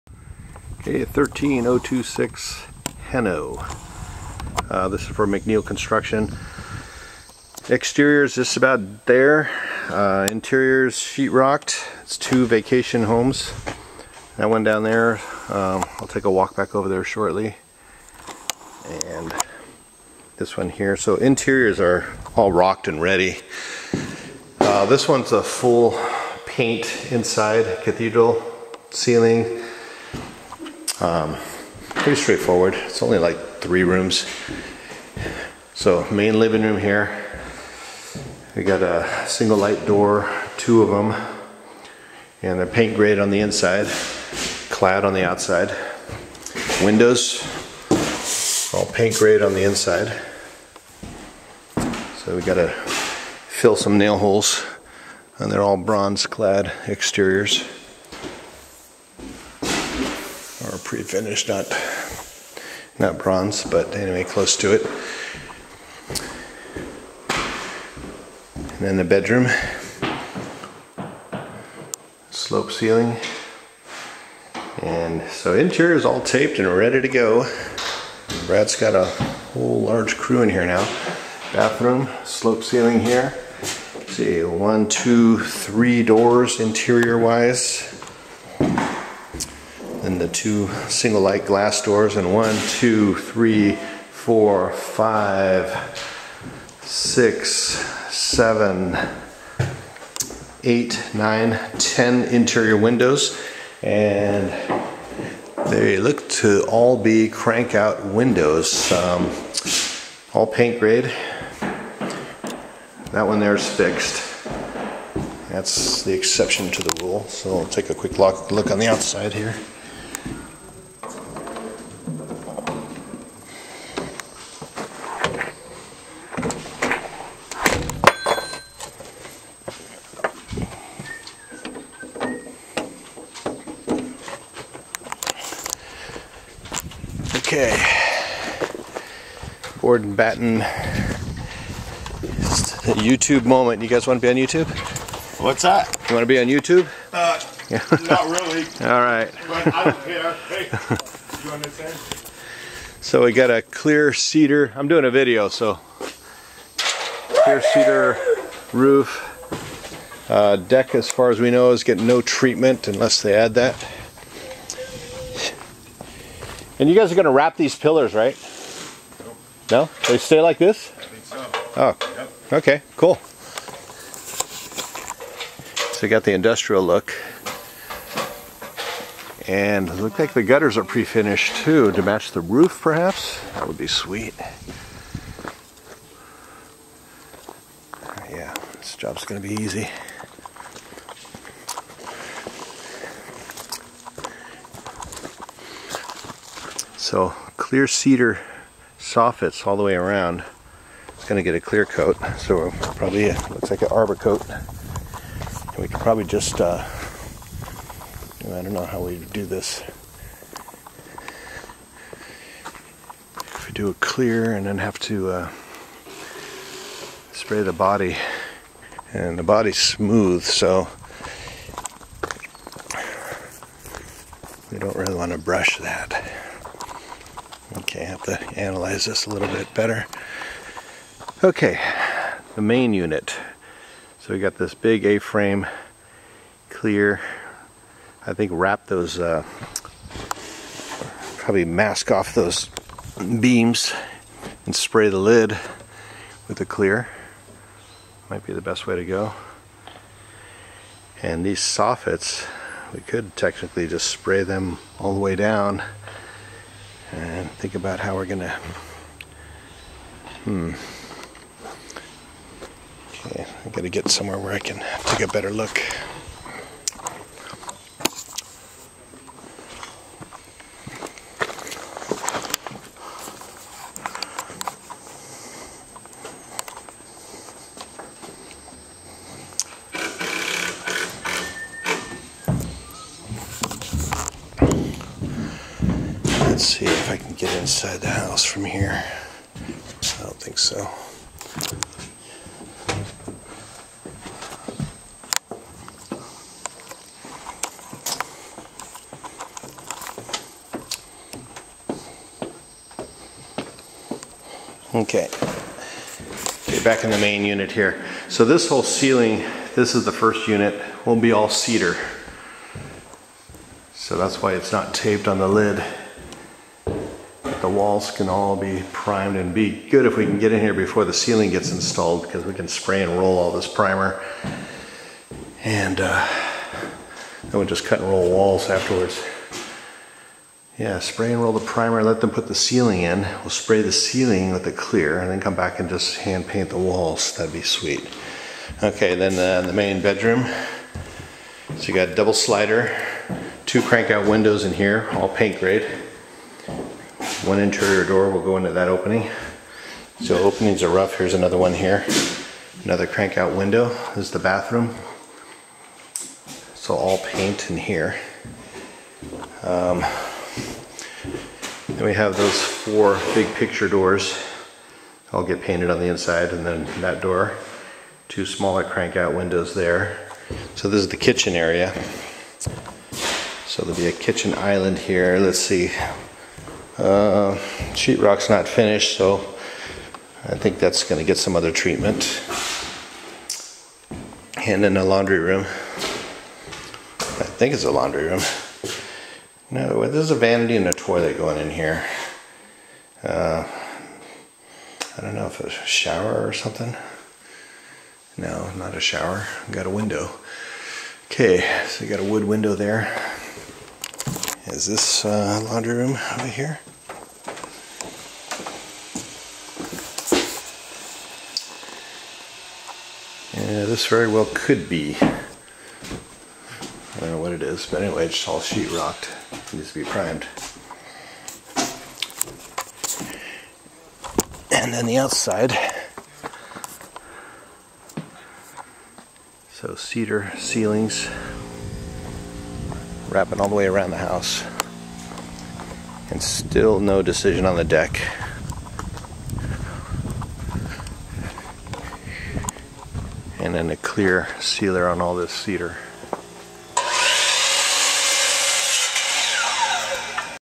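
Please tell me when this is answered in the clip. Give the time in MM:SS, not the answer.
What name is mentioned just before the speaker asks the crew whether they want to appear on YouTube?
02:19.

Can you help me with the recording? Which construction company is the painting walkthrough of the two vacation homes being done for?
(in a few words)
McNeil Construction.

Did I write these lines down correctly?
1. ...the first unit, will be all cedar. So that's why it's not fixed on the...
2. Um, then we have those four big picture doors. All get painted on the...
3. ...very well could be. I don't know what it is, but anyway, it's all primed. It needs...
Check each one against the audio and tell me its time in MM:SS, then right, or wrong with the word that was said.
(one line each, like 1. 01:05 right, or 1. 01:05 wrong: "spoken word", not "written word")
1. 05:10 wrong: "taped", not "fixed"
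2. 05:59 right
3. 06:54 wrong: "sheetrocked", not "primed".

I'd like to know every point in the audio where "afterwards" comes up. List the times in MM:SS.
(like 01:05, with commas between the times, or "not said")
05:28.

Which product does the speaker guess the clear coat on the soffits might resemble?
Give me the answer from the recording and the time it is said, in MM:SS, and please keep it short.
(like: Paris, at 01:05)
Arbor coat, at 03:23.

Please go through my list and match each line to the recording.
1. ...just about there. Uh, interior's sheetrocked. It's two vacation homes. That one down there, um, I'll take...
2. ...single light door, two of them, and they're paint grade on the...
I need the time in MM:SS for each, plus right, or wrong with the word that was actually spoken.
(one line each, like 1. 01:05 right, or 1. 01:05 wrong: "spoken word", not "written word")
1. 00:08 right
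2. 00:39 right.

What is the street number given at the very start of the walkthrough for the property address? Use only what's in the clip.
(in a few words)
13026.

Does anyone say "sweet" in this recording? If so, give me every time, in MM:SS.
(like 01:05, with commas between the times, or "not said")
03:03, 05:37.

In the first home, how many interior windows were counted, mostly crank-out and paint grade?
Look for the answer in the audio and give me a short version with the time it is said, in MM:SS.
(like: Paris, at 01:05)
10, at 01:41.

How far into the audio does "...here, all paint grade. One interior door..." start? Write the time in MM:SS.
05:44.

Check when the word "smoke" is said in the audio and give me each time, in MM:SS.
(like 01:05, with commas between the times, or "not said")
not said.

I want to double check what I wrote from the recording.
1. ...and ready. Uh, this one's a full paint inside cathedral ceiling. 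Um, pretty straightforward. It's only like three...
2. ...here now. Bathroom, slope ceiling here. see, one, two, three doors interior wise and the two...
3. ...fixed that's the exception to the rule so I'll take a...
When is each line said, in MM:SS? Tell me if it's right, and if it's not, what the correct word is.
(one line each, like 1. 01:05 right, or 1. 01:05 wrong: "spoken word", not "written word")
1. 00:22 right
2. 01:20 right
3. 01:53 right.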